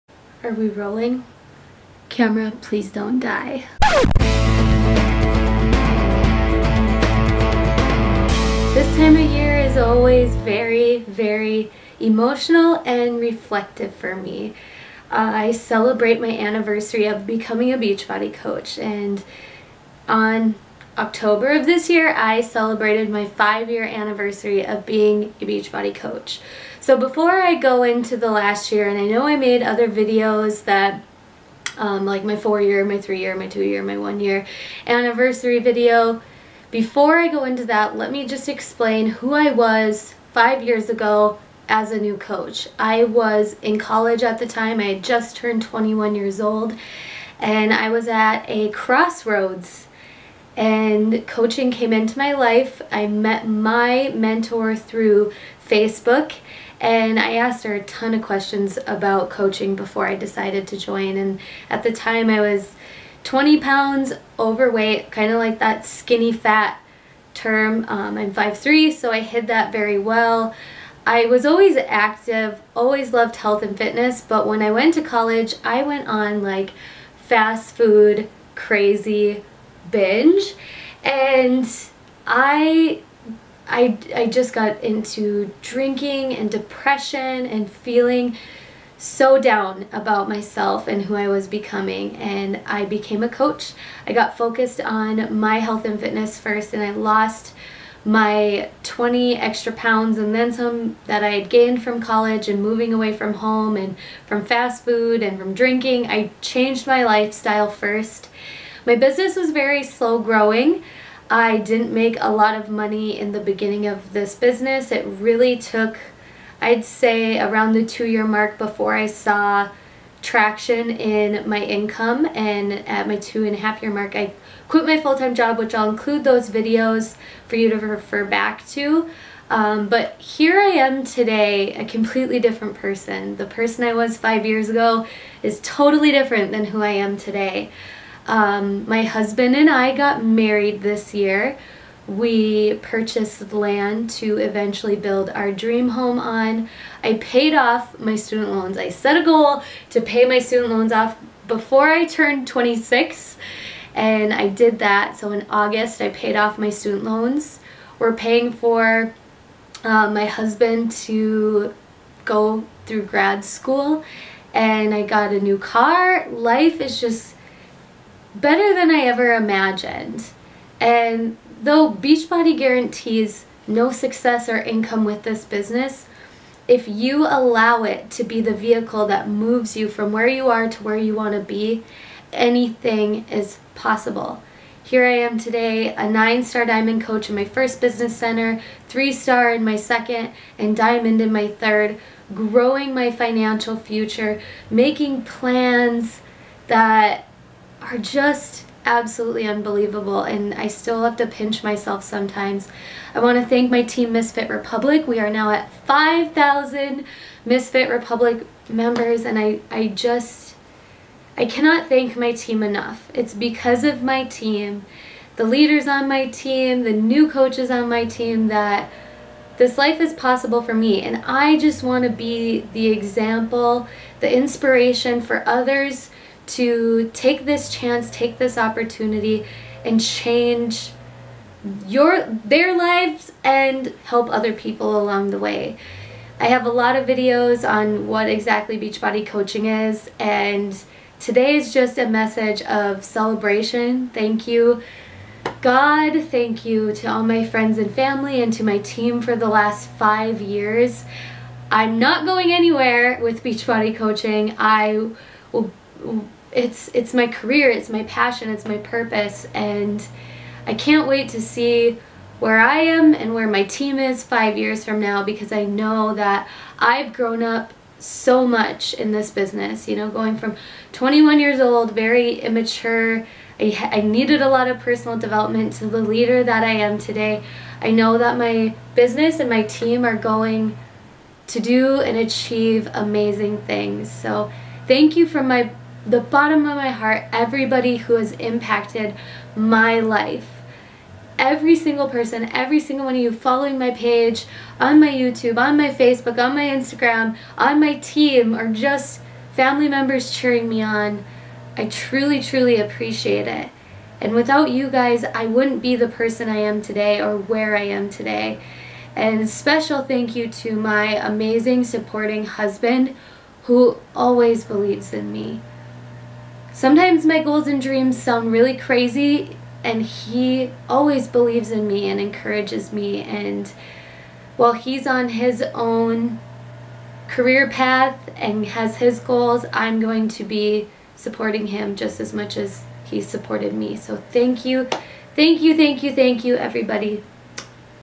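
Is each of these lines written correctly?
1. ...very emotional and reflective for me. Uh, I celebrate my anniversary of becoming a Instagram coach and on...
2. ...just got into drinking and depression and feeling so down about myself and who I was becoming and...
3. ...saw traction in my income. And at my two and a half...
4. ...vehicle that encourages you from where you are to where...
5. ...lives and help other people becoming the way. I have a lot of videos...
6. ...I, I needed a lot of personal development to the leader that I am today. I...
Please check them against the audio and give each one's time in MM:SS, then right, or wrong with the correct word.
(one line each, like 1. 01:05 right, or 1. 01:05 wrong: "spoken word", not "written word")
1. 00:11 wrong: "Beachbody", not "Instagram"
2. 01:24 right
3. 01:59 right
4. 02:58 wrong: "moves", not "encourages"
5. 03:52 wrong: "along", not "becoming"
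6. 04:33 right.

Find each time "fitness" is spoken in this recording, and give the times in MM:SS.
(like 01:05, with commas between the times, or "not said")
01:13, 01:35.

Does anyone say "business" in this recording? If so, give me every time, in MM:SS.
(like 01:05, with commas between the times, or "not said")
01:48, 01:54, 02:55, 03:07, 04:29, 04:38.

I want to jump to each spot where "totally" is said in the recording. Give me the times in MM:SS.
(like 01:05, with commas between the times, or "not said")
02:15.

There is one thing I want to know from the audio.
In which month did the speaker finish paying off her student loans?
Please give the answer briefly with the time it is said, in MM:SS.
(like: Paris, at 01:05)
August, at 02:35.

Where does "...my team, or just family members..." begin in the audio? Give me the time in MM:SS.
04:57.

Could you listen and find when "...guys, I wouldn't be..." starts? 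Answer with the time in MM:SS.
05:04.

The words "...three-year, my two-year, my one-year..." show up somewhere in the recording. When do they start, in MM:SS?
00:32.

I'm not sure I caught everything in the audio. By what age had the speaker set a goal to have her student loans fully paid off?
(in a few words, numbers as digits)
26.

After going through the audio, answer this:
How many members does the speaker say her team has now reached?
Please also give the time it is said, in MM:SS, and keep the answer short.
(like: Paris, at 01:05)
5,000, at 03:25.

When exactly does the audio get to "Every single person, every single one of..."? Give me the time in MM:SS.
04:51.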